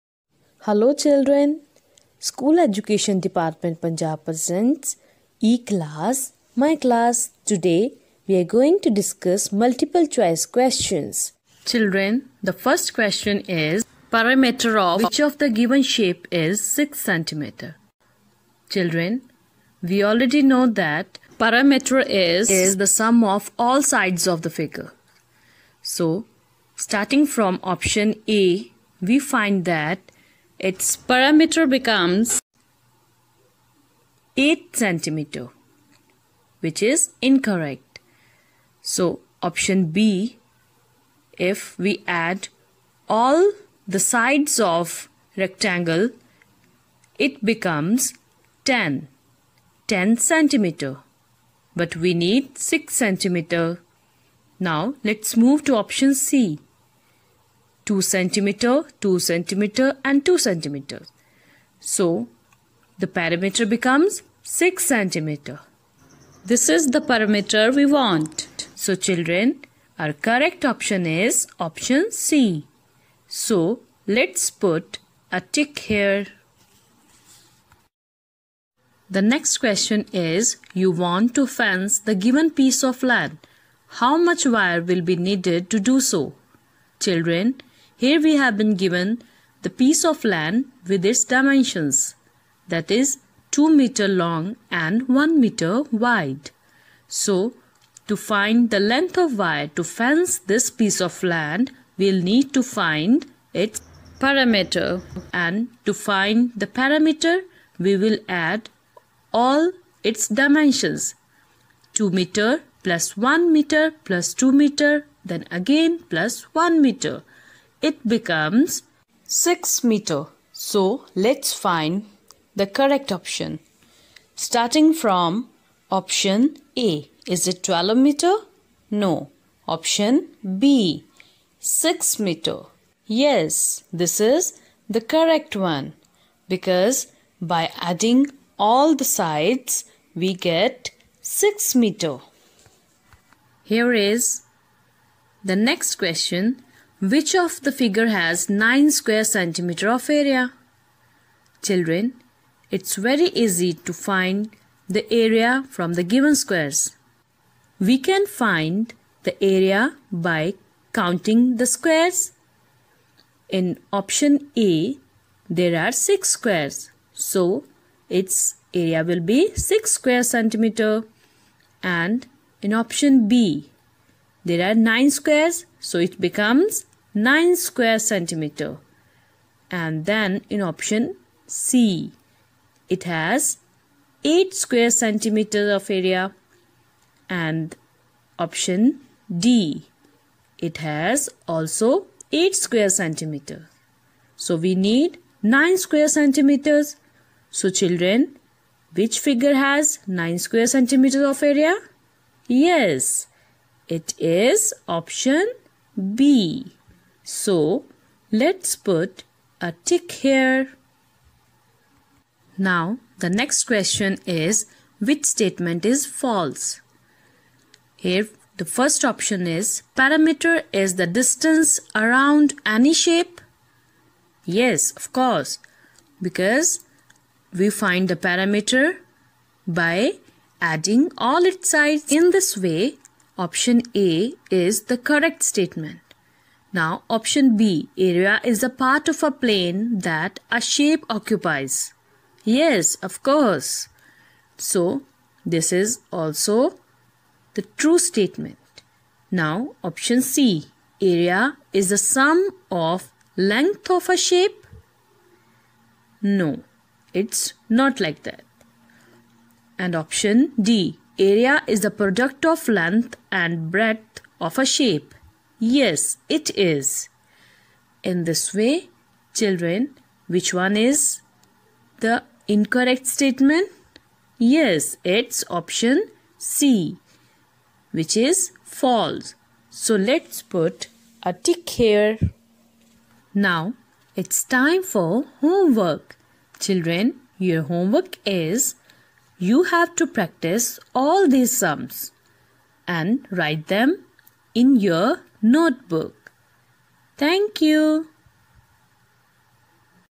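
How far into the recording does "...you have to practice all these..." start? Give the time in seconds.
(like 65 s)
289 s.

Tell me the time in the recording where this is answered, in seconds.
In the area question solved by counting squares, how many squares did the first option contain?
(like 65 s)
165 s.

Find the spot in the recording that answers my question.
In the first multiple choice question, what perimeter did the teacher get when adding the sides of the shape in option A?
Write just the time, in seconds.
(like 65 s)
34 s.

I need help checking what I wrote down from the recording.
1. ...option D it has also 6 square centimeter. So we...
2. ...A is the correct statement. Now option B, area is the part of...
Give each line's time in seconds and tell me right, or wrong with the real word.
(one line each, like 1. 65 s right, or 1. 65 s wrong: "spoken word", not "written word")
1. 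188 s wrong: "8", not "6"
2. 233 s right.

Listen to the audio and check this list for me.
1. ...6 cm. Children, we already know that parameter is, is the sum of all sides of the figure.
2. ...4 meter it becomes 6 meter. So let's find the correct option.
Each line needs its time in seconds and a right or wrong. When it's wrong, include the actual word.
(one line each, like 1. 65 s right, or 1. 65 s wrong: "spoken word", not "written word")
1. 16 s right
2. 116 s wrong: "1", not "4".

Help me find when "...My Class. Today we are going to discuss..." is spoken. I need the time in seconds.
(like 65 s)
6 s.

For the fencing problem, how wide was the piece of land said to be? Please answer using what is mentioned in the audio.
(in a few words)
1 meter.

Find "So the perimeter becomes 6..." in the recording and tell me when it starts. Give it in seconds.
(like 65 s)
61 s.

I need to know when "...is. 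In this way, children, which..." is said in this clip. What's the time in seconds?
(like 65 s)
266 s.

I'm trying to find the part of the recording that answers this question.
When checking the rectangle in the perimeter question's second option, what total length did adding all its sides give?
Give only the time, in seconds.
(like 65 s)
49 s.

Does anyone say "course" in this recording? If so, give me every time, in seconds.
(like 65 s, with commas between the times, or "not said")
225 s, 243 s.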